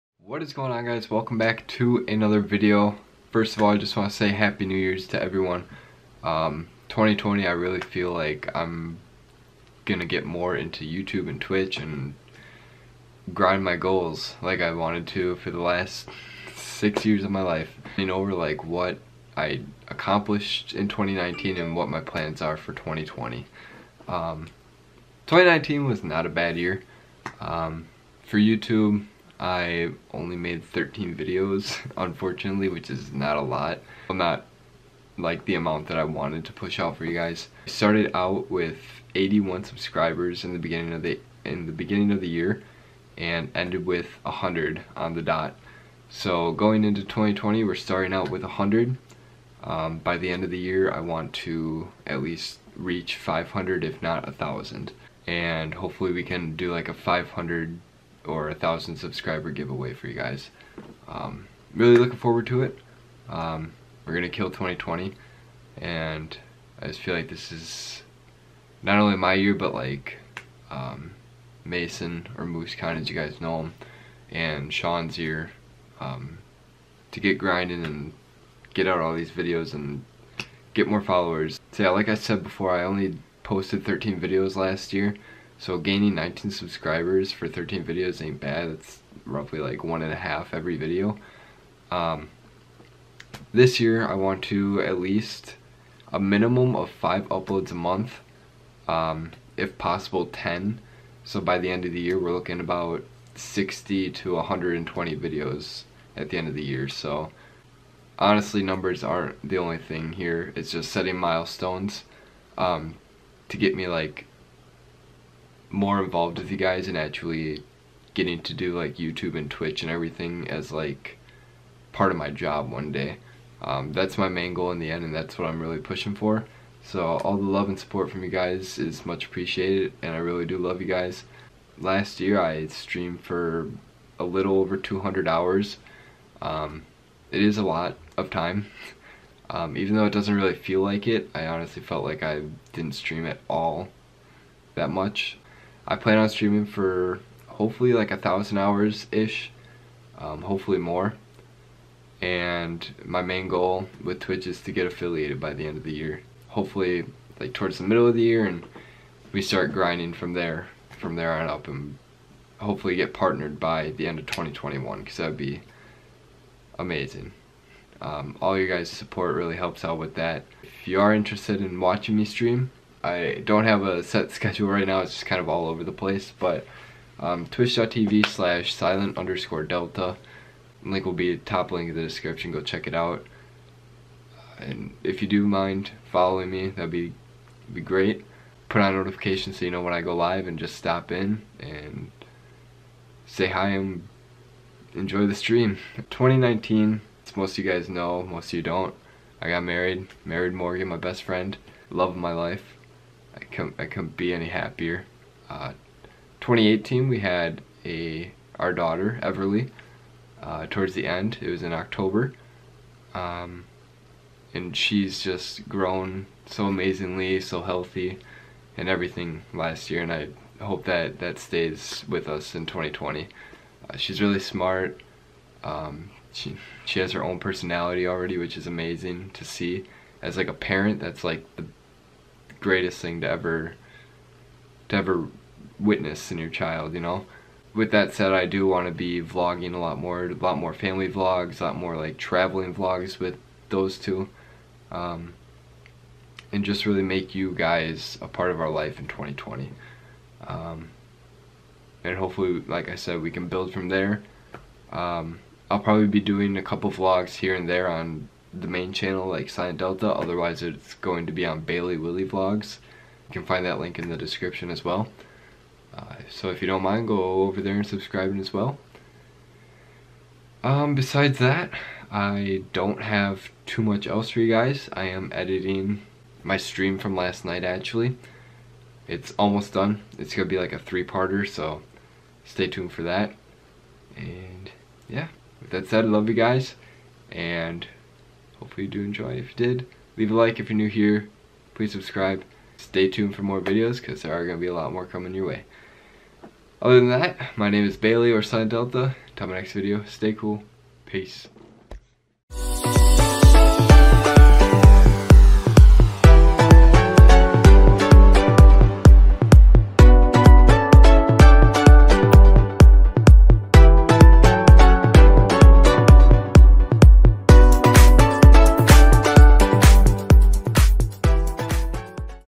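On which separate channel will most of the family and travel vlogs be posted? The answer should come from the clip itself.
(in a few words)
Bailey Willie Vlogs.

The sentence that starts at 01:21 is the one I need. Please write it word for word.
So yeah, like I said before, I only posted 13 videos last year.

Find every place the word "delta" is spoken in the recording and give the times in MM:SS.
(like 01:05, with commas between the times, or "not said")
02:59, 04:19, 04:58.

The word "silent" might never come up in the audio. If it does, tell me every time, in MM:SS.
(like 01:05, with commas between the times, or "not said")
02:58, 04:19, 04:58.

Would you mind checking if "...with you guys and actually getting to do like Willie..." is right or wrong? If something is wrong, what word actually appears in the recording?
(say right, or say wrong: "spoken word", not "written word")
wrong: "YouTube", not "Willie".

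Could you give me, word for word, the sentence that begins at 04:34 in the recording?
I am editing my stream from last night actually.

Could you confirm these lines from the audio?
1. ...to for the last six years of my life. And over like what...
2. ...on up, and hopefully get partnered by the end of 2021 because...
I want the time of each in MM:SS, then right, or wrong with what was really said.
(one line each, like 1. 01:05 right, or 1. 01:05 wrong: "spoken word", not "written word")
1. 00:15 right
2. 02:41 right.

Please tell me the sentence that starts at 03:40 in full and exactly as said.
And I hope that that stays with us in 2020.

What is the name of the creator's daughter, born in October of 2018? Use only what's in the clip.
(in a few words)
Everly.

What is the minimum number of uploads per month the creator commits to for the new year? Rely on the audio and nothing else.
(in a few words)
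5.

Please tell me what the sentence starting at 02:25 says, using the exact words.
I plan on streaming for hopefully like a thousand hours ish, um, hopefully more.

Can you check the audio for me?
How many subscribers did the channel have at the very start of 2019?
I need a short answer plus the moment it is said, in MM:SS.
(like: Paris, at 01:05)
81, at 00:39.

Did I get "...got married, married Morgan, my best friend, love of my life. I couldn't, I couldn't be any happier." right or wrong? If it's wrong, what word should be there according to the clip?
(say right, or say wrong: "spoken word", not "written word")
right.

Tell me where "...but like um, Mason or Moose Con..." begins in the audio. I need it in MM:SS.
01:09.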